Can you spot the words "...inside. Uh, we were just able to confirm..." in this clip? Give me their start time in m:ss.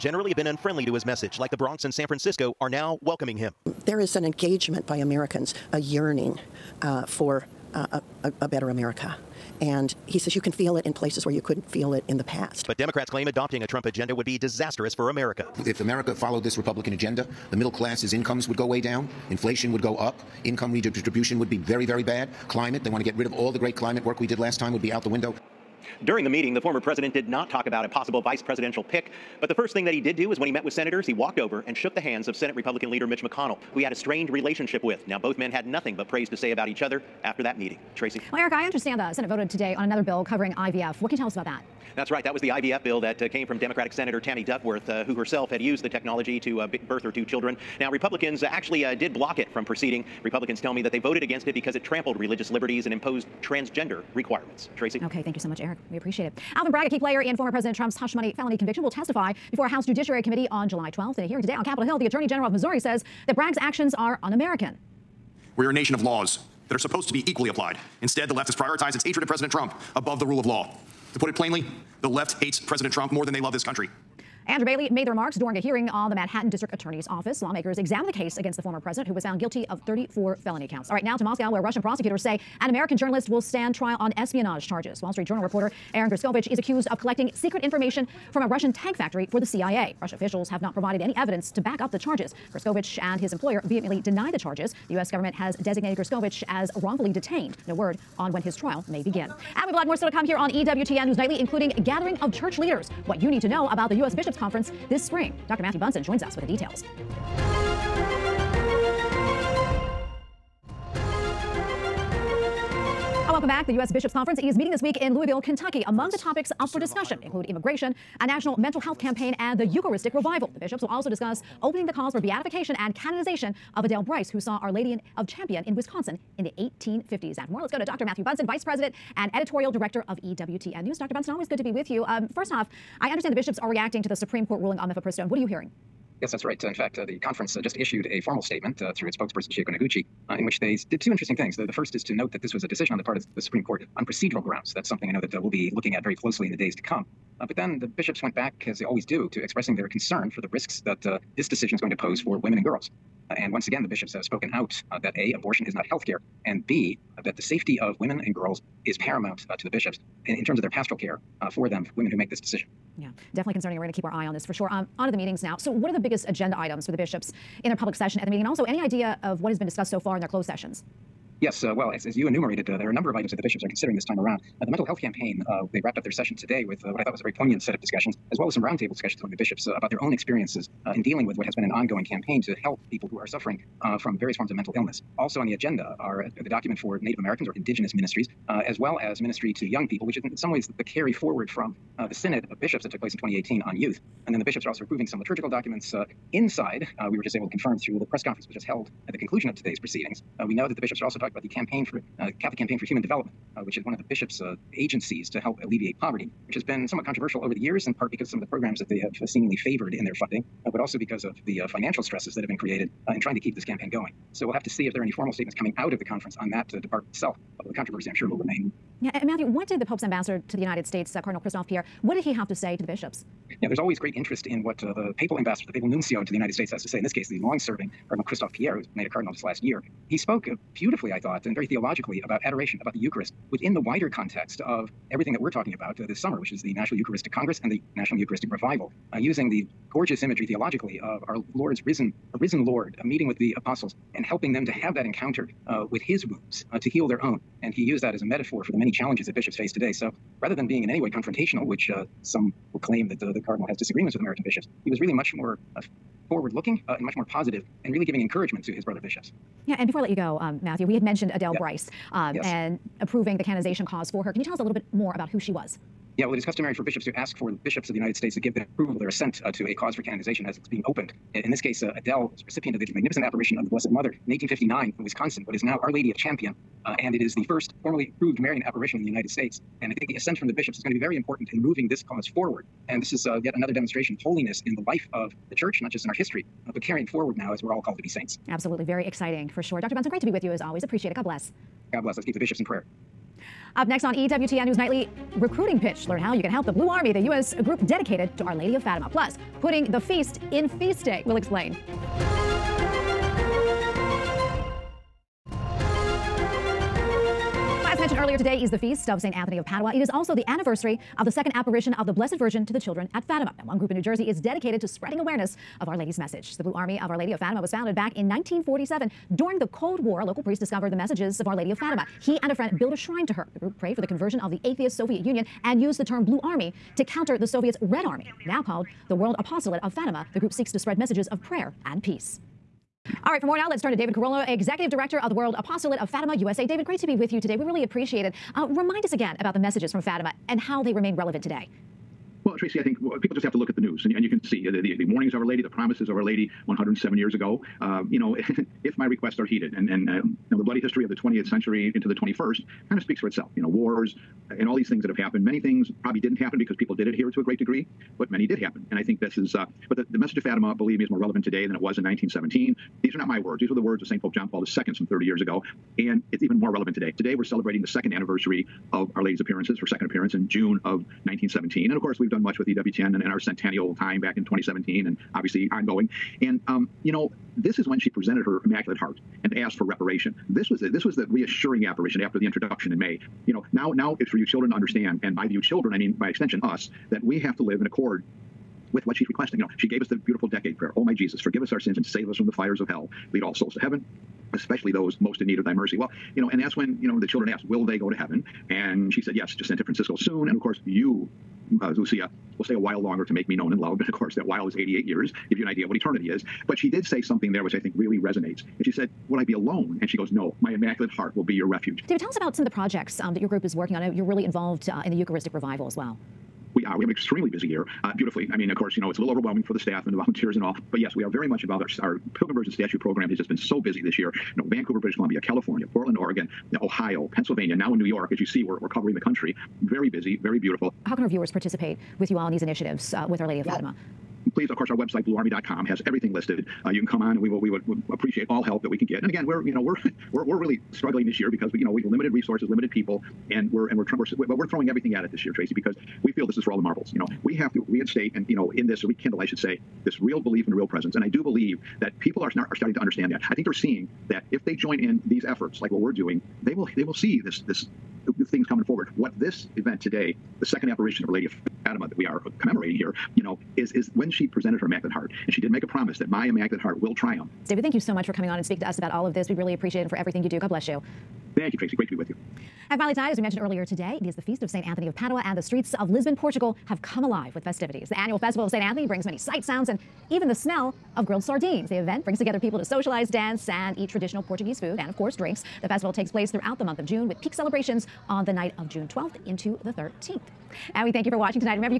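3:16.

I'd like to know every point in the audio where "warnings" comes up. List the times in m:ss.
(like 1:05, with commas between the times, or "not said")
5:45.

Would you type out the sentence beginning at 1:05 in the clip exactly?
We are a nation of laws that are supposed to be equally applied.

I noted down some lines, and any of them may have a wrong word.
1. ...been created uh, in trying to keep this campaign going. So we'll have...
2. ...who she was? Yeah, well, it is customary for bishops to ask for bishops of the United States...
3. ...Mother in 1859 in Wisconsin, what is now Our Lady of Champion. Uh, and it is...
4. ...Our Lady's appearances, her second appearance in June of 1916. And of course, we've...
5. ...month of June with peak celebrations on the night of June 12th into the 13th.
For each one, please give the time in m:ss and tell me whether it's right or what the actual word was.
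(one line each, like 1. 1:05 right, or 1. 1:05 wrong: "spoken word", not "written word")
1. 3:32 right
2. 4:25 right
3. 4:33 right
4. 6:09 wrong: "1917", not "1916"
5. 8:06 right.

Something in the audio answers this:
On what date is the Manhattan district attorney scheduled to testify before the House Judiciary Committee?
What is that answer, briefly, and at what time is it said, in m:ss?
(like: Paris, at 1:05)
July 12th, at 1:00.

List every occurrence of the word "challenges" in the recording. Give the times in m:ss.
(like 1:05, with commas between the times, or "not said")
4:08.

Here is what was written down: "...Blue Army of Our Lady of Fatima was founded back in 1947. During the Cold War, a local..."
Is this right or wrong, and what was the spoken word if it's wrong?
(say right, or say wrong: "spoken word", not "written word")
right.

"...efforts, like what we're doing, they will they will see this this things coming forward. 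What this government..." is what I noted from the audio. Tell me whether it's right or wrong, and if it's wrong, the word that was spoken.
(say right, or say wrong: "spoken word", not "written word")
wrong: "event", not "government".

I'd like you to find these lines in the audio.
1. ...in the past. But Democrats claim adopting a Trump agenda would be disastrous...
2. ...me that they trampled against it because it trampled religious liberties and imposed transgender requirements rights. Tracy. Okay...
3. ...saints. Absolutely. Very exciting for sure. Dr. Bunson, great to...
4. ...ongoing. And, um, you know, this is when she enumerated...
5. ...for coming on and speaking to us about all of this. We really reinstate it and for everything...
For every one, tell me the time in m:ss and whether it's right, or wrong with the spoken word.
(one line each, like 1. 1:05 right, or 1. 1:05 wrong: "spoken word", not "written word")
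1. 0:12 right
2. 0:50 wrong: "voted", not "trampled"
3. 4:48 right
4. 6:15 wrong: "presented", not "enumerated"
5. 7:48 wrong: "appreciate", not "reinstate".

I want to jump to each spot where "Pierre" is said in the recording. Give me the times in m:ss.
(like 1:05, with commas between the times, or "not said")
3:41, 3:48.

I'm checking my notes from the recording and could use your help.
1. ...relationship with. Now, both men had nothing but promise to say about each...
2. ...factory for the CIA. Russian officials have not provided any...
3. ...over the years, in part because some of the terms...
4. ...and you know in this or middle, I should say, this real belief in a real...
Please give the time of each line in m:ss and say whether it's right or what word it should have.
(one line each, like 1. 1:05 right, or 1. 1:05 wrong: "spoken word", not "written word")
1. 0:34 wrong: "praise", not "promise"
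2. 1:28 right
3. 3:27 wrong: "programs", not "terms"
4. 7:28 wrong: "rekindle", not "middle".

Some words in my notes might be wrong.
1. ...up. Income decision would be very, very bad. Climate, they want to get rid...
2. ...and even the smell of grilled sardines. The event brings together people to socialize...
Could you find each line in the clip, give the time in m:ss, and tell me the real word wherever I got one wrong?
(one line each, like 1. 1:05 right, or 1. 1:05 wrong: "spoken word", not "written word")
1. 0:19 wrong: "redistribution", not "decision"
2. 7:59 right.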